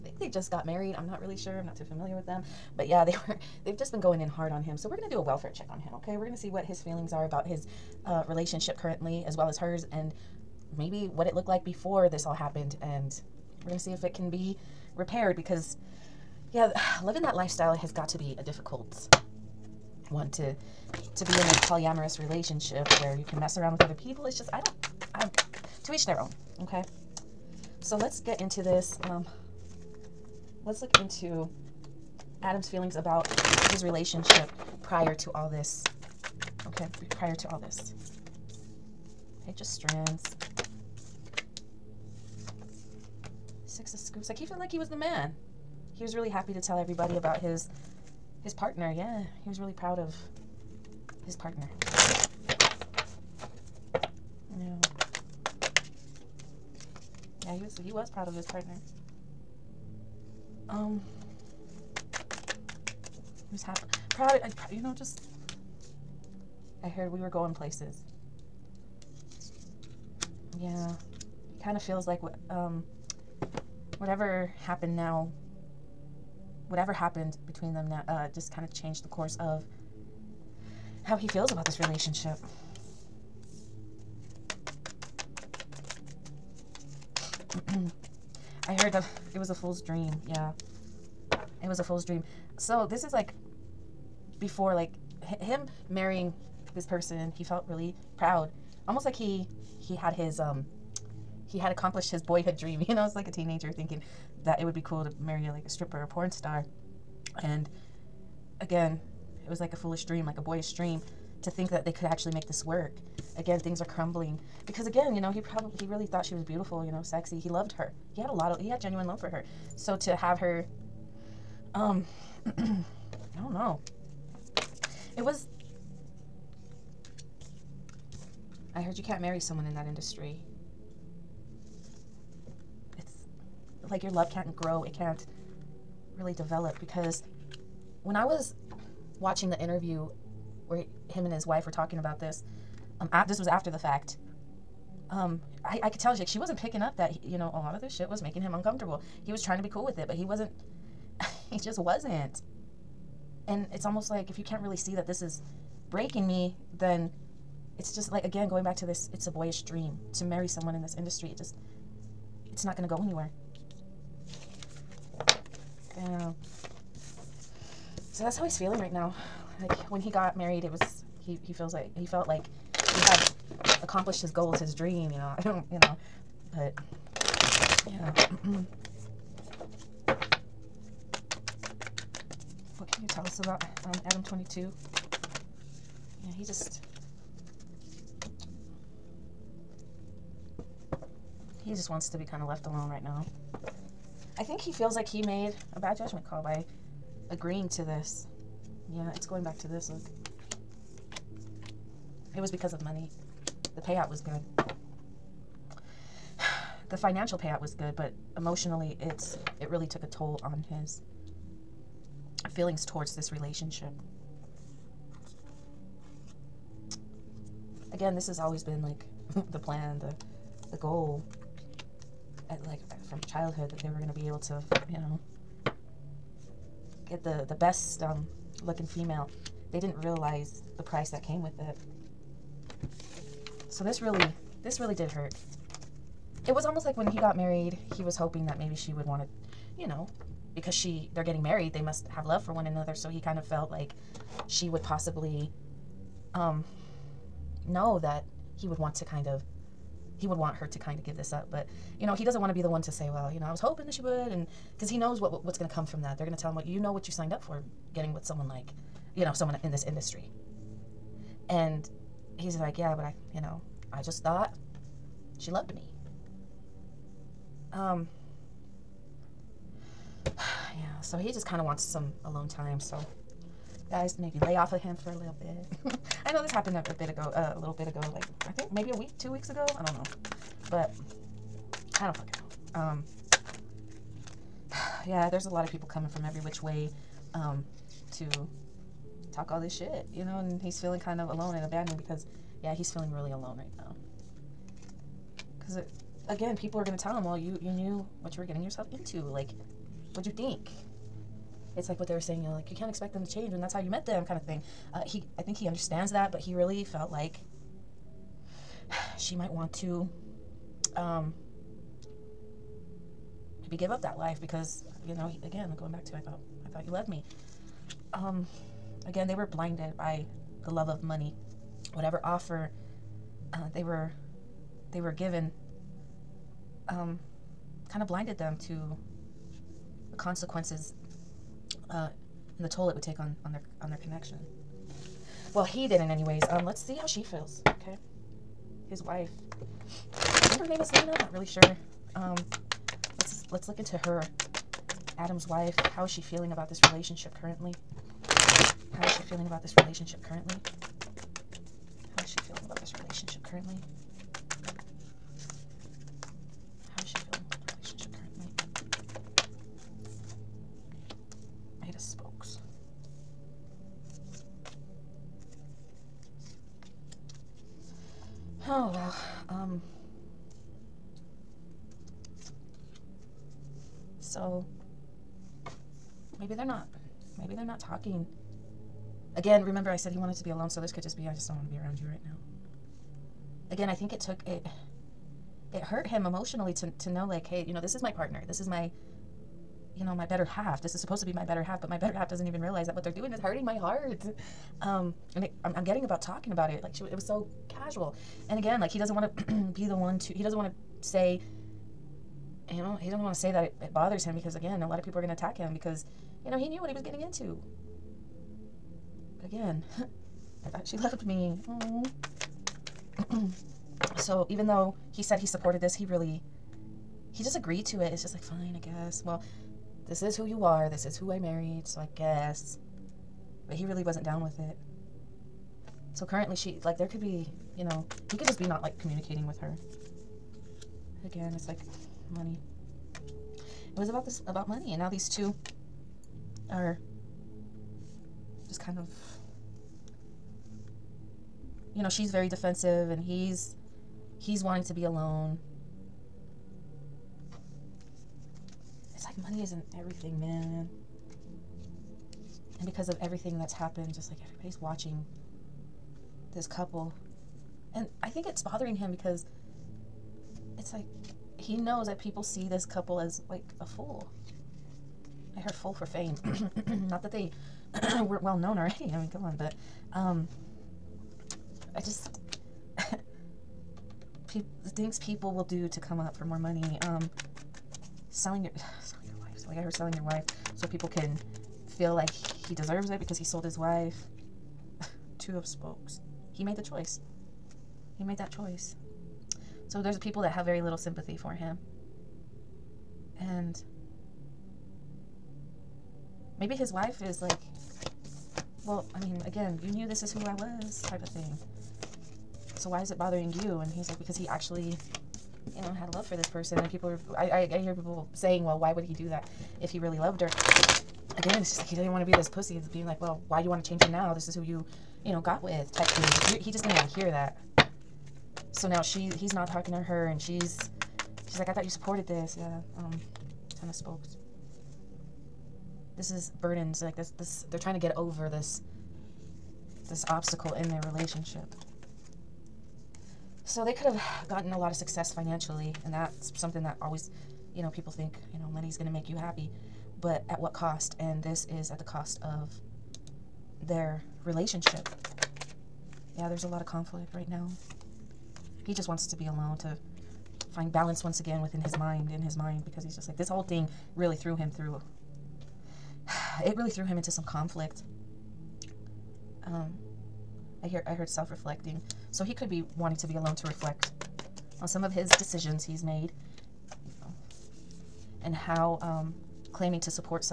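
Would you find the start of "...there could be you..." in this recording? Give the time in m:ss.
7:06.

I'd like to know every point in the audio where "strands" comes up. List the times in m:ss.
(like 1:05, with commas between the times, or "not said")
0:39.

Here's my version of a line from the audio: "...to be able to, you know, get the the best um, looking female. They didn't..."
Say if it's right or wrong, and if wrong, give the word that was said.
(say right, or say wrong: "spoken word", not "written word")
right.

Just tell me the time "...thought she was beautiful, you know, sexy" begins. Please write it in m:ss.
1:56.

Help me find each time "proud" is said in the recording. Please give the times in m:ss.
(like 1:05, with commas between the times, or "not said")
0:49, 0:58, 1:04, 1:38.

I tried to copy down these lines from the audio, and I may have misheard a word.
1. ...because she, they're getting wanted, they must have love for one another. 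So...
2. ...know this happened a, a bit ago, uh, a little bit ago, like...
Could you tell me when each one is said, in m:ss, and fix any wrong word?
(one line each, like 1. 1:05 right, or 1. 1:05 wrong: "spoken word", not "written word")
1. 4:00 wrong: "married", not "wanted"
2. 4:36 right.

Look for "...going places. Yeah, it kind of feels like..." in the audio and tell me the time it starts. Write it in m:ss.
1:07.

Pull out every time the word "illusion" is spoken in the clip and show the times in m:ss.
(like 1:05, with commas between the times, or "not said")
not said.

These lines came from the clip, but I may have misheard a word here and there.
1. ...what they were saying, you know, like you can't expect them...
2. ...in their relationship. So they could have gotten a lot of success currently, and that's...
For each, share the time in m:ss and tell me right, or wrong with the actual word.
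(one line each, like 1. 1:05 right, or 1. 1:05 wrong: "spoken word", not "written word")
1. 5:01 right
2. 8:50 wrong: "financially", not "currently".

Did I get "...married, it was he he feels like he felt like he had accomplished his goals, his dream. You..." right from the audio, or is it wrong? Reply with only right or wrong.
right.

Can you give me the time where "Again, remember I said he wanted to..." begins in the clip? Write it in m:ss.
6:19.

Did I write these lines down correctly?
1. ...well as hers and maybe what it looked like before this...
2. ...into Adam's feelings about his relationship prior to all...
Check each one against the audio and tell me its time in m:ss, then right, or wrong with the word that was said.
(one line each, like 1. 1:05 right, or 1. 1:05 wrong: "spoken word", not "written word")
1. 0:09 right
2. 0:30 right.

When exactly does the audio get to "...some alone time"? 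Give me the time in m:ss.
4:31.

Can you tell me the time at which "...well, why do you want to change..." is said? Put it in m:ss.
8:33.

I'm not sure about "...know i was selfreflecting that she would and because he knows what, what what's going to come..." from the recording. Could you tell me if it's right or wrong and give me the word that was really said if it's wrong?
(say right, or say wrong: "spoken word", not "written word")
wrong: "hoping", not "selfreflecting".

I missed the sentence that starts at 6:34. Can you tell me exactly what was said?
Um, and it, I'm, I'm getting about talking about it.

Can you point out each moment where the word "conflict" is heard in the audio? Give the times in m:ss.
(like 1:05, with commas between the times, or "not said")
9:06, 9:17.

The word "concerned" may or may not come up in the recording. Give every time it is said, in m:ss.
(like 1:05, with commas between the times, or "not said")
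not said.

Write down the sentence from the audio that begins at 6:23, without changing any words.
Again, I think it took it it hurt him emotionally to to know like, hey, you know, this is my partner.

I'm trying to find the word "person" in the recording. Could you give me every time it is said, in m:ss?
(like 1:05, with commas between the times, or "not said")
1:36, 8:26.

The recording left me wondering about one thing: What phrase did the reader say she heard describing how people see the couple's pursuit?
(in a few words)
fool for fame.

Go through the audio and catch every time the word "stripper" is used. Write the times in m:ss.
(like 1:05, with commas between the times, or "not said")
1:45.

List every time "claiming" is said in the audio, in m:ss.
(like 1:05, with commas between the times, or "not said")
9:29.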